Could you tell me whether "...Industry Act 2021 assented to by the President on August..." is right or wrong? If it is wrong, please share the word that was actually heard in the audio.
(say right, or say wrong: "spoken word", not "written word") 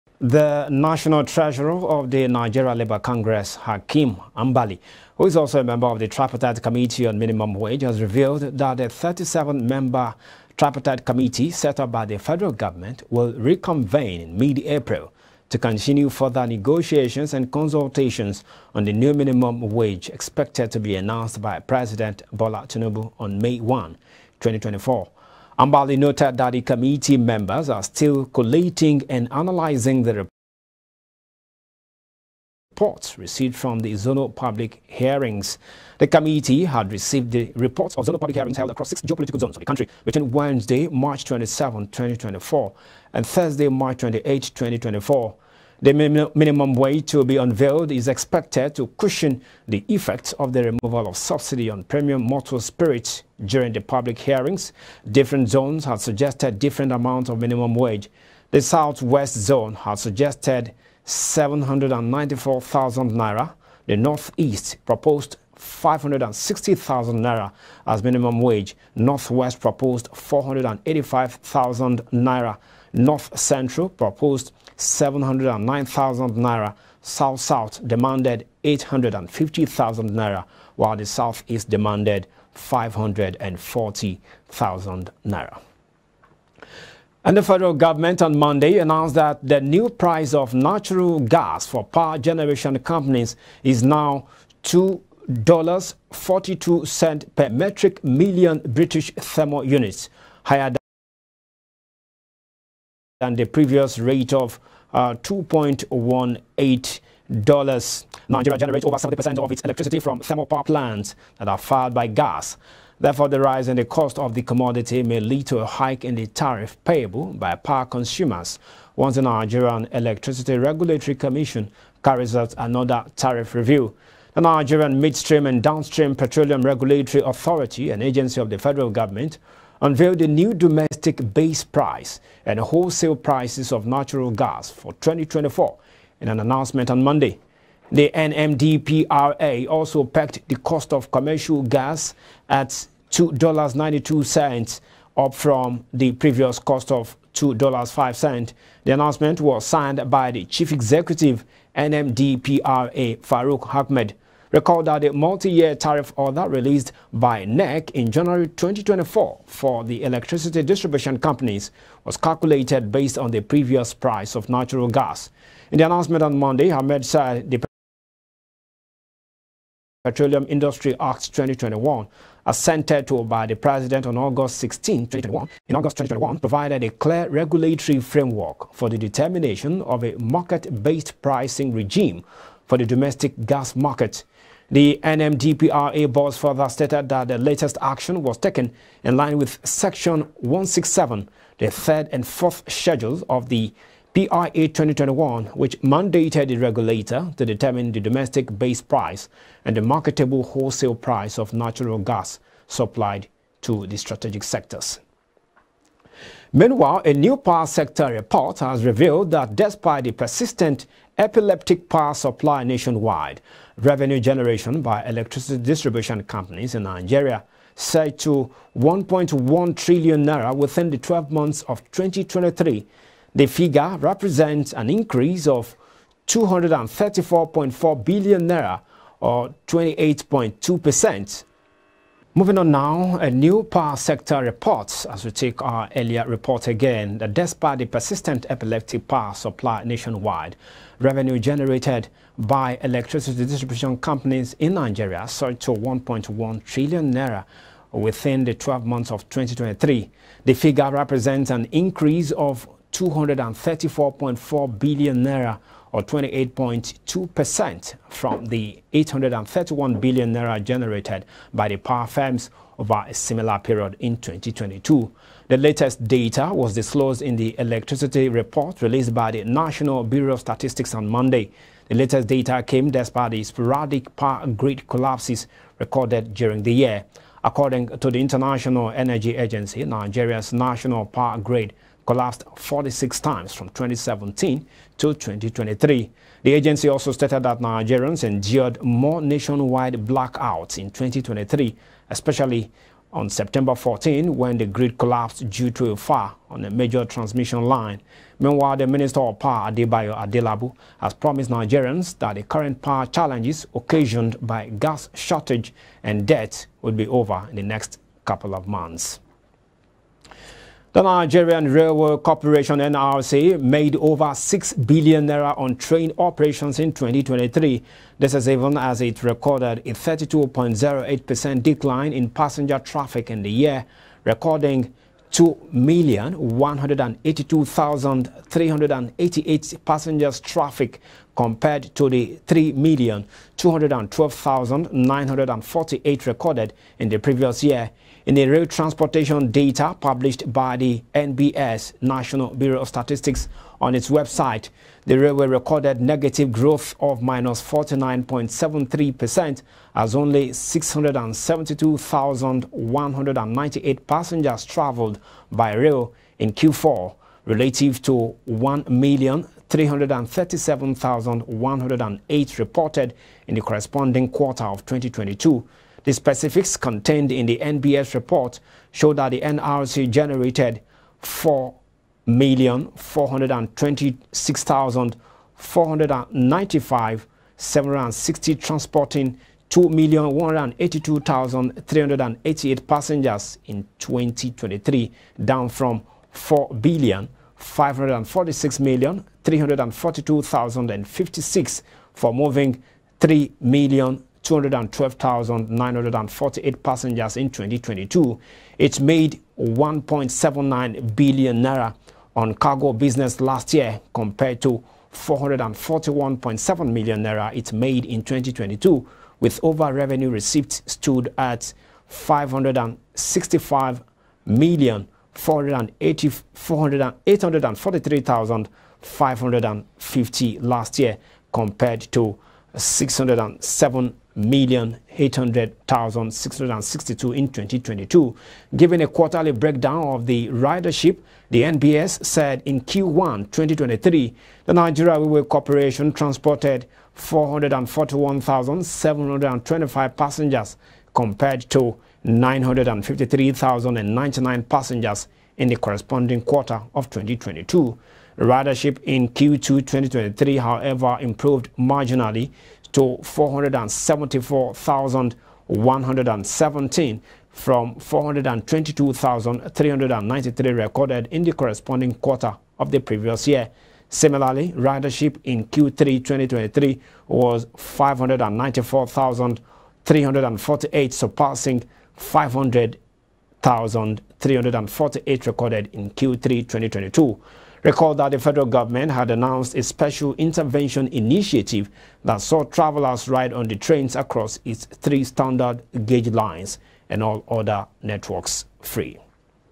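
right.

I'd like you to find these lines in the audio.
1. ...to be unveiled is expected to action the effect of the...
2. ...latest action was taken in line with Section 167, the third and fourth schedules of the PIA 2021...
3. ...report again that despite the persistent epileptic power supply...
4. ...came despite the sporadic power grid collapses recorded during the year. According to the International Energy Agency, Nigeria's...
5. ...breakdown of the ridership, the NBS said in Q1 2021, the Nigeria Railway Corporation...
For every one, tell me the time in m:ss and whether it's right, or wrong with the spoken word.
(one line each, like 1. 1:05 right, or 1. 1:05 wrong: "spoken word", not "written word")
1. 0:47 wrong: "cushion", not "action"
2. 3:07 right
3. 3:56 right
4. 4:32 right
5. 7:09 wrong: "2023", not "2021".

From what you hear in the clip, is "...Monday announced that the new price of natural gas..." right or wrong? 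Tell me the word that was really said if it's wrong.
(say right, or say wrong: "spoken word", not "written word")
right.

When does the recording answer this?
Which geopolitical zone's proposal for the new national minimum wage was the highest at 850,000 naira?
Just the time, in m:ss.
1:17.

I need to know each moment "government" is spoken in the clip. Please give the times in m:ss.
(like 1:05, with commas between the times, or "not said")
0:12, 1:27, 2:08, 7:58.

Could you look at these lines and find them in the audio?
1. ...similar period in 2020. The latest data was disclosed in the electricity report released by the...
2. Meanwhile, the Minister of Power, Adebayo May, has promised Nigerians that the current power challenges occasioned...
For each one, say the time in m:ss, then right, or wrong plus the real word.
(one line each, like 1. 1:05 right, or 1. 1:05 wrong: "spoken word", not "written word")
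1. 4:23 wrong: "2022", not "2020"
2. 4:58 wrong: "Adelabu", not "May".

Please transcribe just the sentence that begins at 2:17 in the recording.
The NMDPRA also pegged the cost of commercial gas at $2.92, up from the previous cost of $2.05.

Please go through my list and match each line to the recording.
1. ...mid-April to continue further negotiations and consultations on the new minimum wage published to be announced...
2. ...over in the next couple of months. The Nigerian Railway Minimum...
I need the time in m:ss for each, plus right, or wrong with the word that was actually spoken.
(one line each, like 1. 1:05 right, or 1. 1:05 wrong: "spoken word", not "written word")
1. 0:14 wrong: "expected", not "published"
2. 5:07 wrong: "Corporation", not "Minimum".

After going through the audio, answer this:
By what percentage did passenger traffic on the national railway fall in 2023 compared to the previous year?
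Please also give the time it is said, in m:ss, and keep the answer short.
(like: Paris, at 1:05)
32.08%, at 5:19.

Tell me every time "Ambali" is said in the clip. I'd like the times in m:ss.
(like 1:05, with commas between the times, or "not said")
0:04, 0:25.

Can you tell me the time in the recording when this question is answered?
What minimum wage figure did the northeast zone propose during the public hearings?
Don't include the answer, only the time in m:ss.
1:05.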